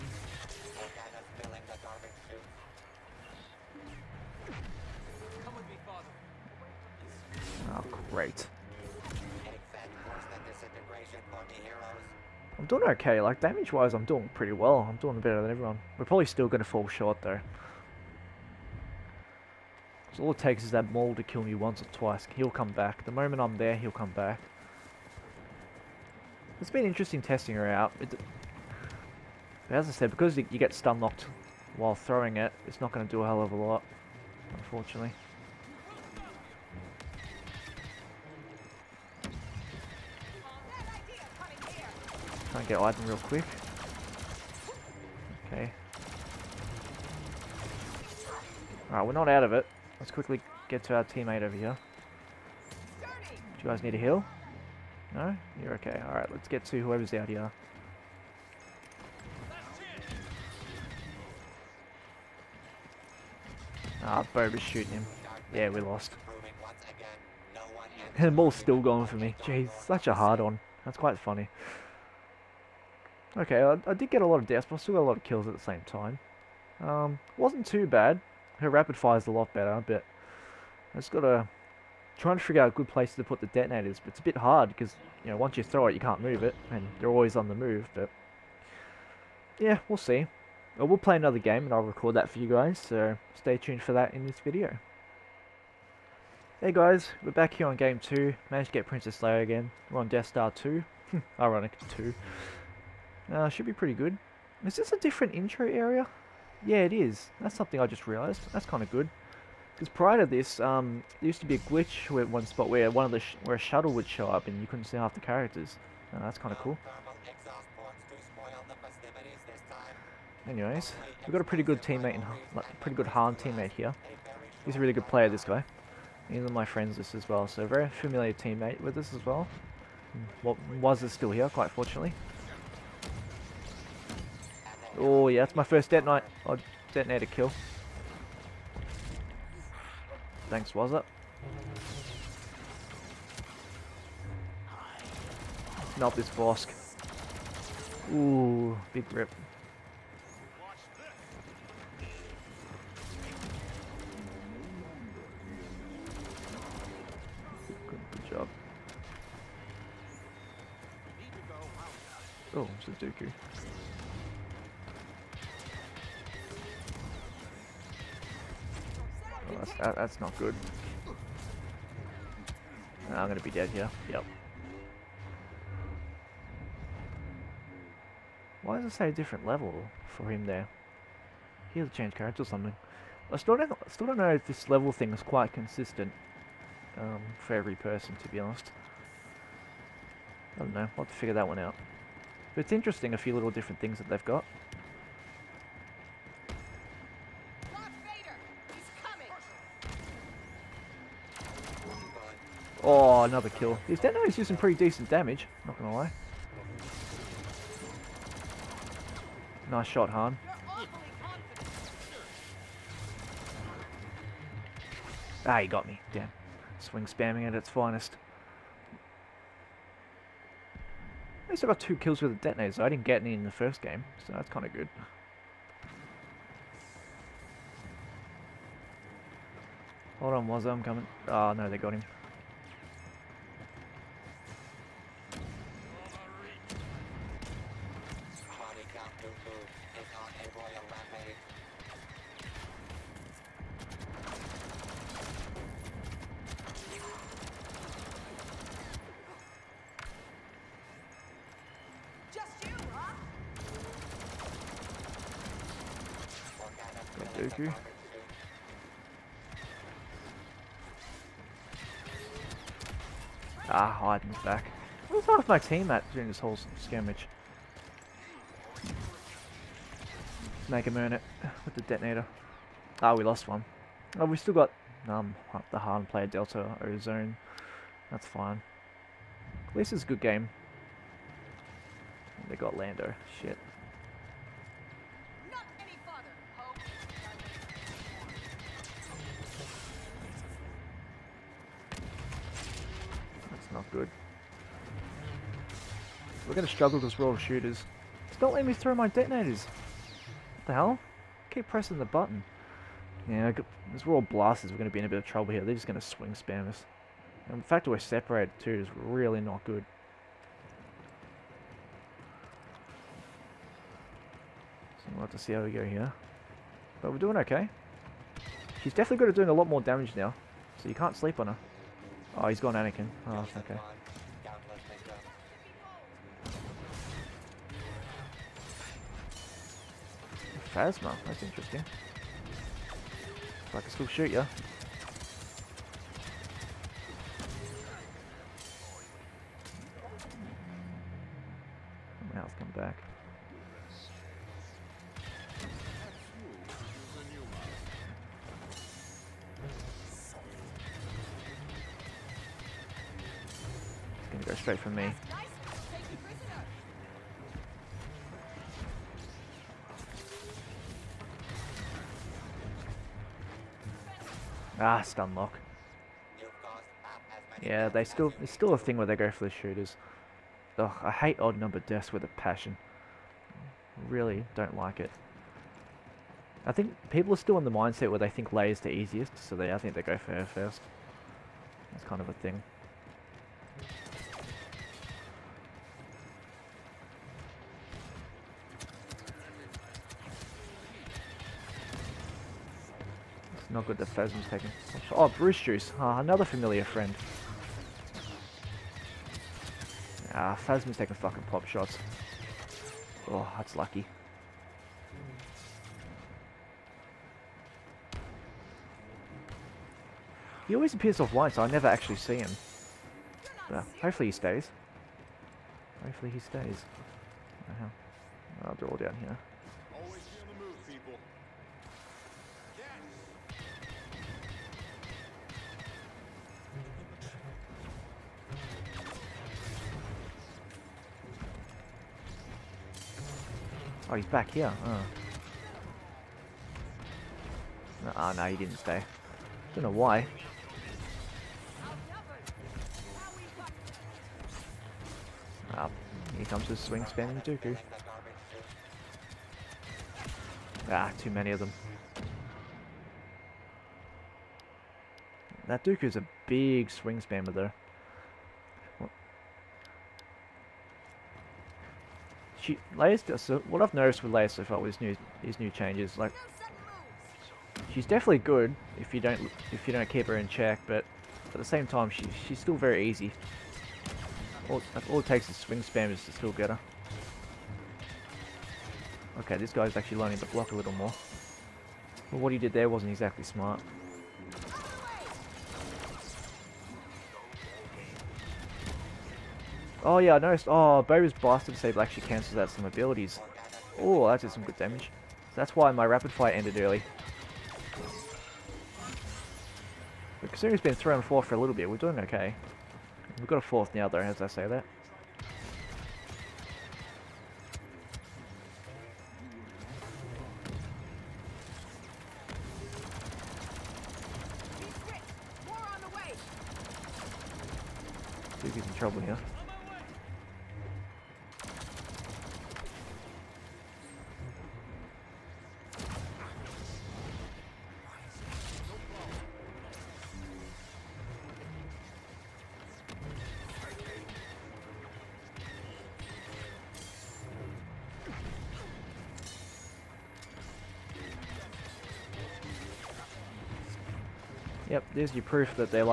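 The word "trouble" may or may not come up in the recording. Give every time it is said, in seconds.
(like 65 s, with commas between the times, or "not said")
305 s, 518 s.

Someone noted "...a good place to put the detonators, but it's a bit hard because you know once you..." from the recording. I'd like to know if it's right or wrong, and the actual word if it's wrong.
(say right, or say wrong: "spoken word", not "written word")
right.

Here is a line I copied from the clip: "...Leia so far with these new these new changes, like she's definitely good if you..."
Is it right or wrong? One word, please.
right.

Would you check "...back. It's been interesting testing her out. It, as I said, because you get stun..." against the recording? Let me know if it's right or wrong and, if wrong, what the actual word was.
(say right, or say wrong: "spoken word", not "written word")
right.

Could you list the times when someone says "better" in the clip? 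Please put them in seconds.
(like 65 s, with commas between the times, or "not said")
15 s, 79 s.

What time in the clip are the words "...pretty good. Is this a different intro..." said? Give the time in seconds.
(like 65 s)
103 s.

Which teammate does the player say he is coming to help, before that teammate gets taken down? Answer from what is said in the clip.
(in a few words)
Wazza.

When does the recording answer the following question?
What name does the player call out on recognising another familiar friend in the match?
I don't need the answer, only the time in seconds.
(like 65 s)
395 s.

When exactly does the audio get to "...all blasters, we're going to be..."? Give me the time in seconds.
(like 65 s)
304 s.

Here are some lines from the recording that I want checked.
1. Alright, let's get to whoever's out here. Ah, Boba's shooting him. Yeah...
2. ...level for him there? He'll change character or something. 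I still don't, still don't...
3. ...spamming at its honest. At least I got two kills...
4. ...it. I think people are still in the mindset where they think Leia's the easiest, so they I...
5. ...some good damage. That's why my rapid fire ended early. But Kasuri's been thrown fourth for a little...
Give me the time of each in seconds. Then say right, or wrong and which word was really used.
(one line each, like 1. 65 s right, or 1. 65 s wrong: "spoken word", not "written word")
1. 56 s right
2. 179 s right
3. 217 s wrong: "finest", not "honest"
4. 374 s right
5. 494 s right.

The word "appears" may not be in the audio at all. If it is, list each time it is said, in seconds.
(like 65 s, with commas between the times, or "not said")
410 s.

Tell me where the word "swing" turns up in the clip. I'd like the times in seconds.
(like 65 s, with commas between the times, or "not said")
216 s, 306 s, 446 s, 456 s, 475 s.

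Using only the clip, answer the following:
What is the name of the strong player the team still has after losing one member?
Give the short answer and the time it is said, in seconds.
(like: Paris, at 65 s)
Delta Ozone, at 276 s.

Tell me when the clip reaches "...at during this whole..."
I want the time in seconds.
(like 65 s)
265 s.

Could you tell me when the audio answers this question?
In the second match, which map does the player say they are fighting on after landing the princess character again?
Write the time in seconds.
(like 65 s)
100 s.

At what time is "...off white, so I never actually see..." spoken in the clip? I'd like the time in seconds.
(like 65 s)
411 s.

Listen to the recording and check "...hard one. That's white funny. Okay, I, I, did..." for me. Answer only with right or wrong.
wrong.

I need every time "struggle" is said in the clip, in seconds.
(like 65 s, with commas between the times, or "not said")
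296 s.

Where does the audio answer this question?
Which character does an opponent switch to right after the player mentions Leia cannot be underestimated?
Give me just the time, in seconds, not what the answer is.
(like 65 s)
322 s.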